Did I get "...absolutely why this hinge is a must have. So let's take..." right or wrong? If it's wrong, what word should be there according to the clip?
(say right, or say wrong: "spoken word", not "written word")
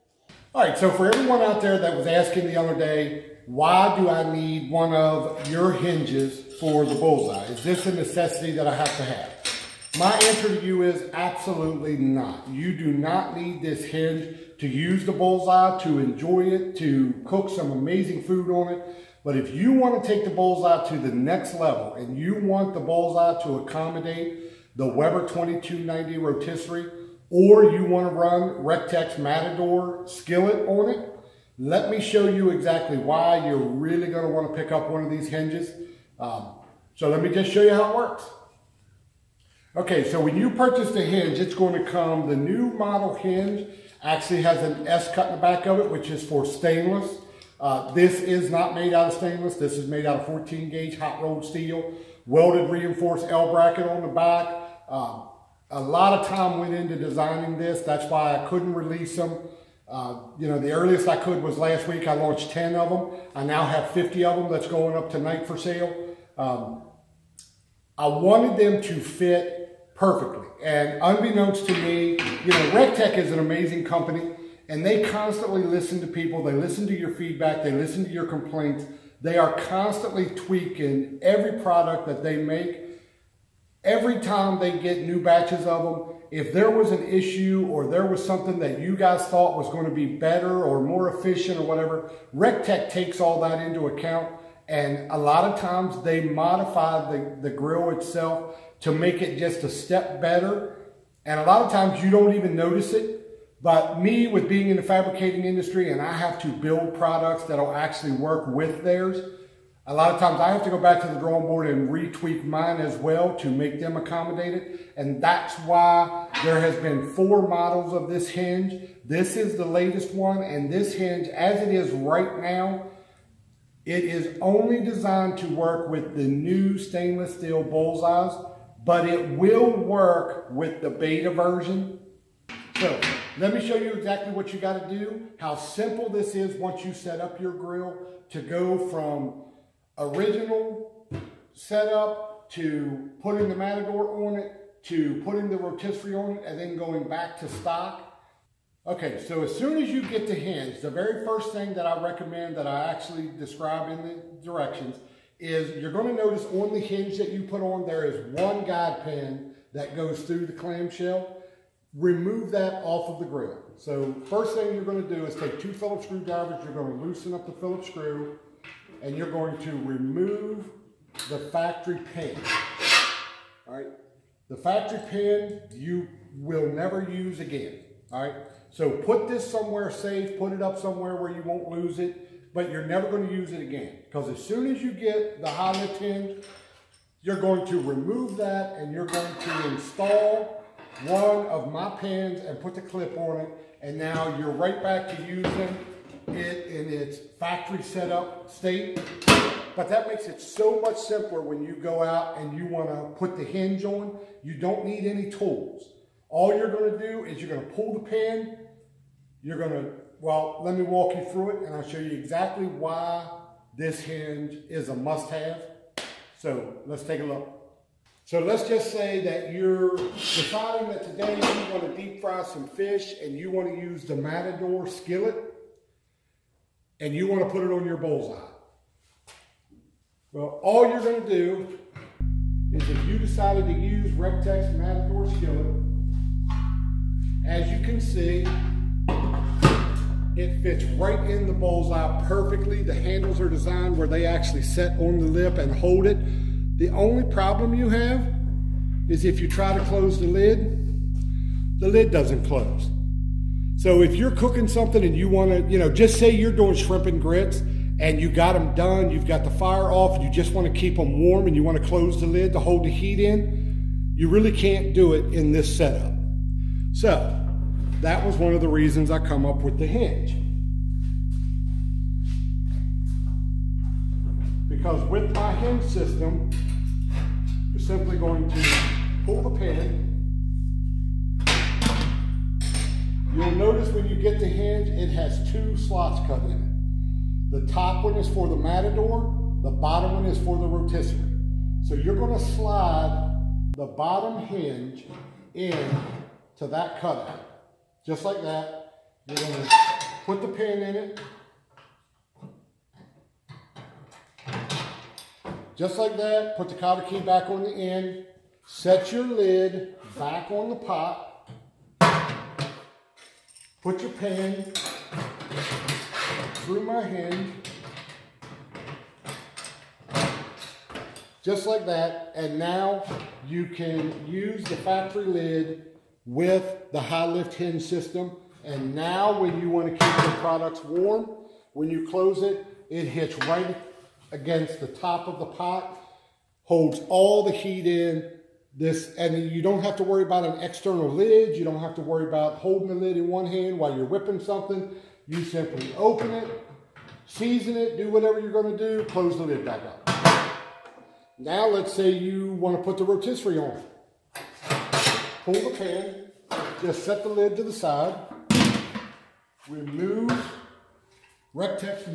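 wrong: "exactly", not "absolutely".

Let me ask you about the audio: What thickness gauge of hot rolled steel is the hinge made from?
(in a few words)
14 gauge.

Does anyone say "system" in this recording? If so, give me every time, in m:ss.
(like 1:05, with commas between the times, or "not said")
4:35, 5:27.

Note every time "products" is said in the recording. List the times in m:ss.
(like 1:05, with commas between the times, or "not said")
1:21, 1:46, 5:30.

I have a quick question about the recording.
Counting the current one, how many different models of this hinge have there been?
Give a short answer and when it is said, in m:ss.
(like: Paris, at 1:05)
4, at 1:57.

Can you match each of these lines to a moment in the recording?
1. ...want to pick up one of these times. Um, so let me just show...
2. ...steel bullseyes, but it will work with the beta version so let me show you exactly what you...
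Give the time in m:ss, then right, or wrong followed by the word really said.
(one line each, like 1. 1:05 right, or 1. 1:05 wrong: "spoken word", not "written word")
1. 0:34 wrong: "hinges", not "times"
2. 2:07 right.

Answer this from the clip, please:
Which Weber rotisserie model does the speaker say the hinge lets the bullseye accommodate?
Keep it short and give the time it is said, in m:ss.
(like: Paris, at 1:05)
2290, at 0:24.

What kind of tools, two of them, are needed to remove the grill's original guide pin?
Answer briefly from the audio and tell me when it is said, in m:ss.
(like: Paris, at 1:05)
Phillips screwdrivers, at 2:45.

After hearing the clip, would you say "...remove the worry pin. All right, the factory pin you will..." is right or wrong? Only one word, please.
wrong.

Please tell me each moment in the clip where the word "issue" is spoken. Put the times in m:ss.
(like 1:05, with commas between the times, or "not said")
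1:27.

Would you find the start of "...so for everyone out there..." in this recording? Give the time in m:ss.
0:00.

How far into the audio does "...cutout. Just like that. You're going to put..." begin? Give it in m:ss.
4:56.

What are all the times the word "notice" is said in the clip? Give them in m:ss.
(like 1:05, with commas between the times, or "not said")
1:42, 2:36, 4:43.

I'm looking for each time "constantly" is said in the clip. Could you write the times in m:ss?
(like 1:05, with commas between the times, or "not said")
1:15, 1:19.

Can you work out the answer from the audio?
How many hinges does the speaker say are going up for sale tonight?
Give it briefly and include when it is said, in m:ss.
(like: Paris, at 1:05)
50, at 1:03.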